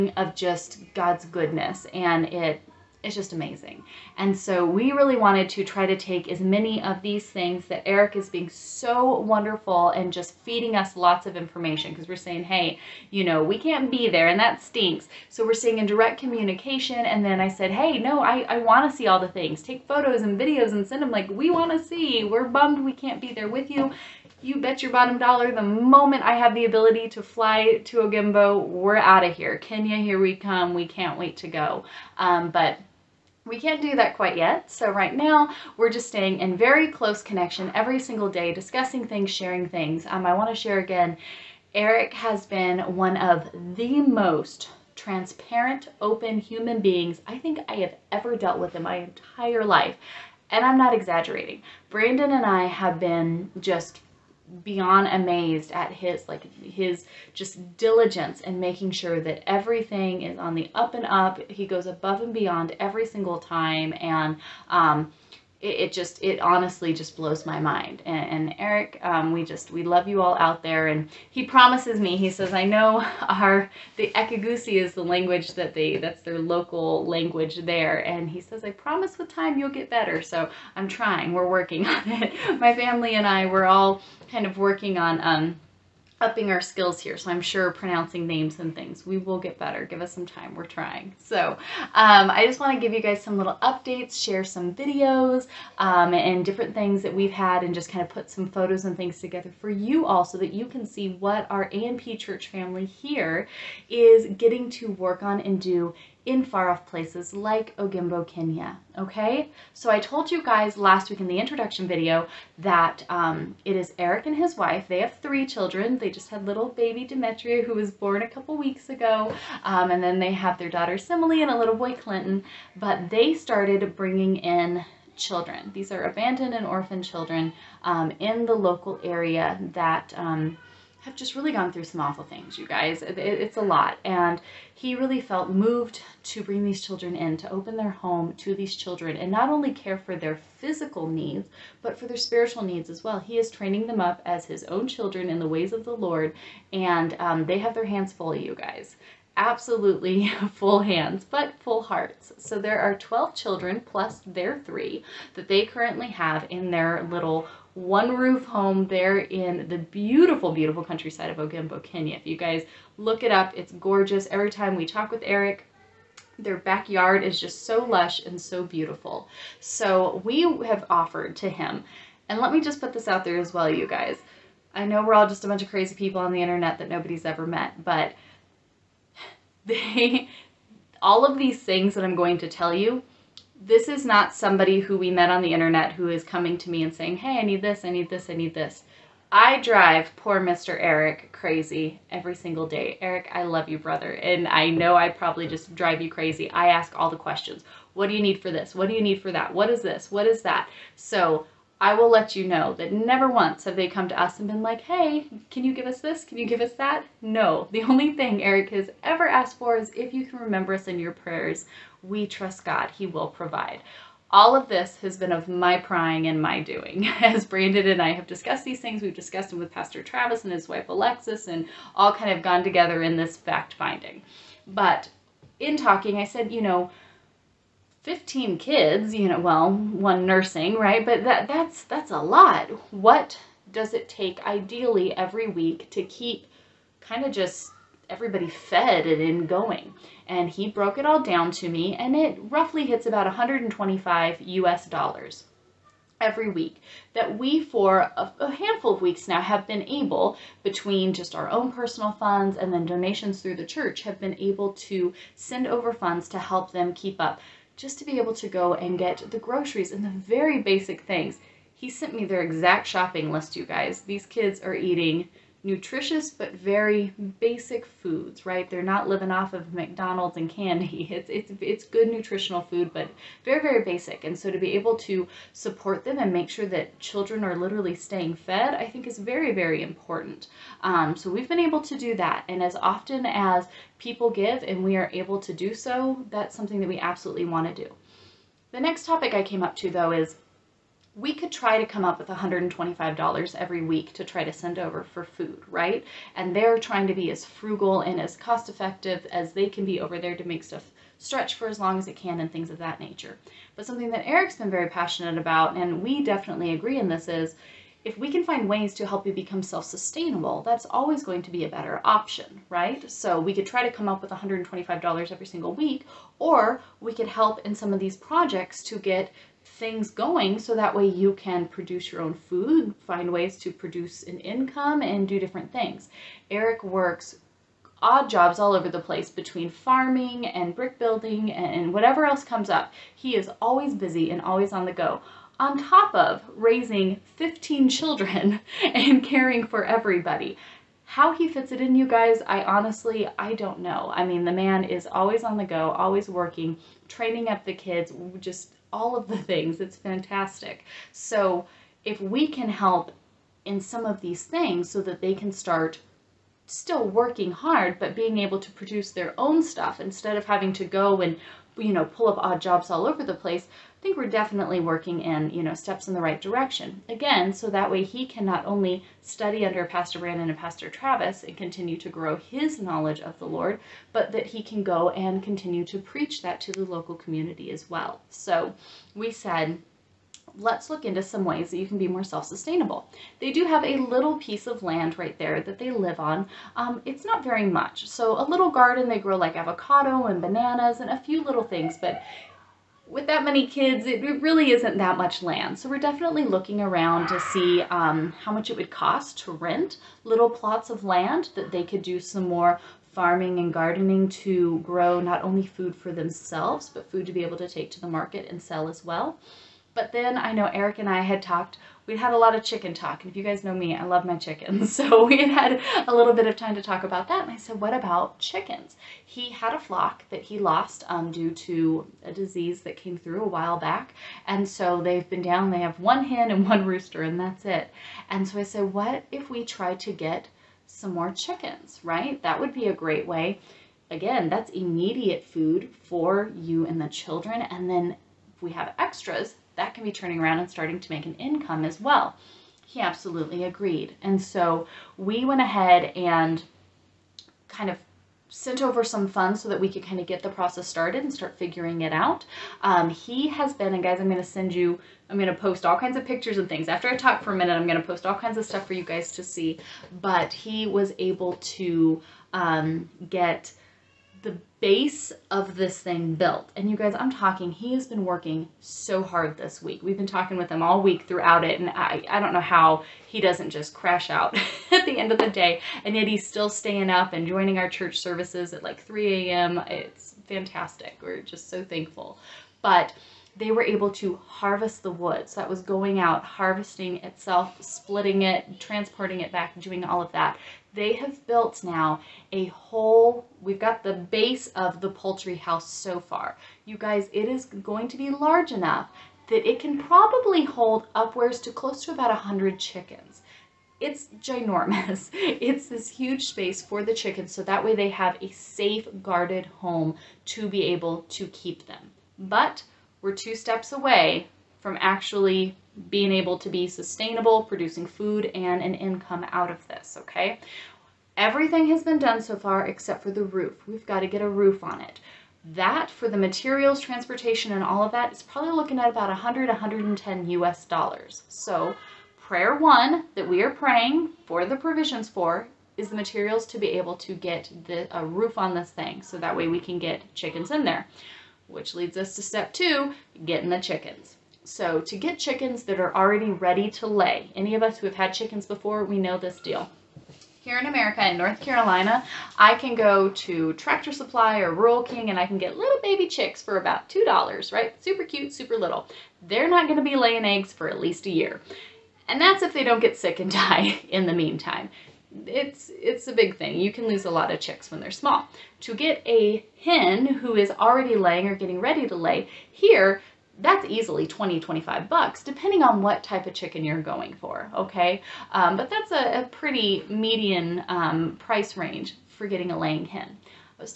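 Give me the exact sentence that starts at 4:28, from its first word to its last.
They're not living off of McDonald's and candy.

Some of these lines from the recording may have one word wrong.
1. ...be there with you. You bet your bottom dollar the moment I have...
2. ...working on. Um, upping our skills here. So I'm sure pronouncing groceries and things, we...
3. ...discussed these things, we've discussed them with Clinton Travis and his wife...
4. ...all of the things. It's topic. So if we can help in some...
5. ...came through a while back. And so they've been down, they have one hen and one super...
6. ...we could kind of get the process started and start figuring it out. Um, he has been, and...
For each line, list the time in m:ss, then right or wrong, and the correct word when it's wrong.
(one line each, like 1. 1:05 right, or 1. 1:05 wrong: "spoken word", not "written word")
1. 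0:23 right
2. 1:24 wrong: "names", not "groceries"
3. 3:38 wrong: "Pastor", not "Clinton"
4. 5:48 wrong: "fantastic", not "topic"
5. 7:02 wrong: "rooster", not "super"
6. 7:29 right.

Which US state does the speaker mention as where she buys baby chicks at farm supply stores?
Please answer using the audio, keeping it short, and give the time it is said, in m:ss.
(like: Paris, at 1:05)
North Carolina, at 9:11.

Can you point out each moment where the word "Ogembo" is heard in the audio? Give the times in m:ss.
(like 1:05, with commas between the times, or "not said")
0:27, 1:47, 2:41.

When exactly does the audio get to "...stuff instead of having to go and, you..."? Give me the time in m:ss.
5:59.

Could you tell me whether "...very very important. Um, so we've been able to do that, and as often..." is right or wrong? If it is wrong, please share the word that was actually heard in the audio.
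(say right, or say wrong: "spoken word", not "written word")
right.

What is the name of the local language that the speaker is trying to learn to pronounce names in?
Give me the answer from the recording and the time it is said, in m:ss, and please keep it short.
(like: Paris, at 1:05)
Ekegusii, at 1:14.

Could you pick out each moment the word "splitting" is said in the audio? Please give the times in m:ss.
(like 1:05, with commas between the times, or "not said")
8:07.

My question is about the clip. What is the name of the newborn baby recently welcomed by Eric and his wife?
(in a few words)
Demetria.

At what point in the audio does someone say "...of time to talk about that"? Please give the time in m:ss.
6:56.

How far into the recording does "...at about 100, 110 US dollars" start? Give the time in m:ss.
8:48.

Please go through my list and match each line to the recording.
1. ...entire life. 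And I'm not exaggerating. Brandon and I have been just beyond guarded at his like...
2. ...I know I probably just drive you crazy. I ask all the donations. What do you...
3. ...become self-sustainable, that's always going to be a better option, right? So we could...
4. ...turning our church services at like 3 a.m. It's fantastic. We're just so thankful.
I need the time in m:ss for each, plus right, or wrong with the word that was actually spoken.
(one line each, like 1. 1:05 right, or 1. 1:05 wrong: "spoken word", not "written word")
1. 0:48 wrong: "amazed", not "guarded"
2. 3:14 wrong: "questions", not "donations"
3. 5:09 right
4. 7:57 wrong: "joining", not "turning".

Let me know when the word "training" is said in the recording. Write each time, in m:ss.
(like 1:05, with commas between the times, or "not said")
2:23, 5:47.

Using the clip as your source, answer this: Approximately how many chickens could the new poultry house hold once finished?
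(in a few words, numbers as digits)
100.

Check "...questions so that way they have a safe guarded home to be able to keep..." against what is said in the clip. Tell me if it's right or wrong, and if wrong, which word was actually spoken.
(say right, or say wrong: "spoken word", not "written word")
wrong: "chickens", not "questions".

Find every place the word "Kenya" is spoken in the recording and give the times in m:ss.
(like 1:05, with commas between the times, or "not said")
0:29, 1:48, 2:41.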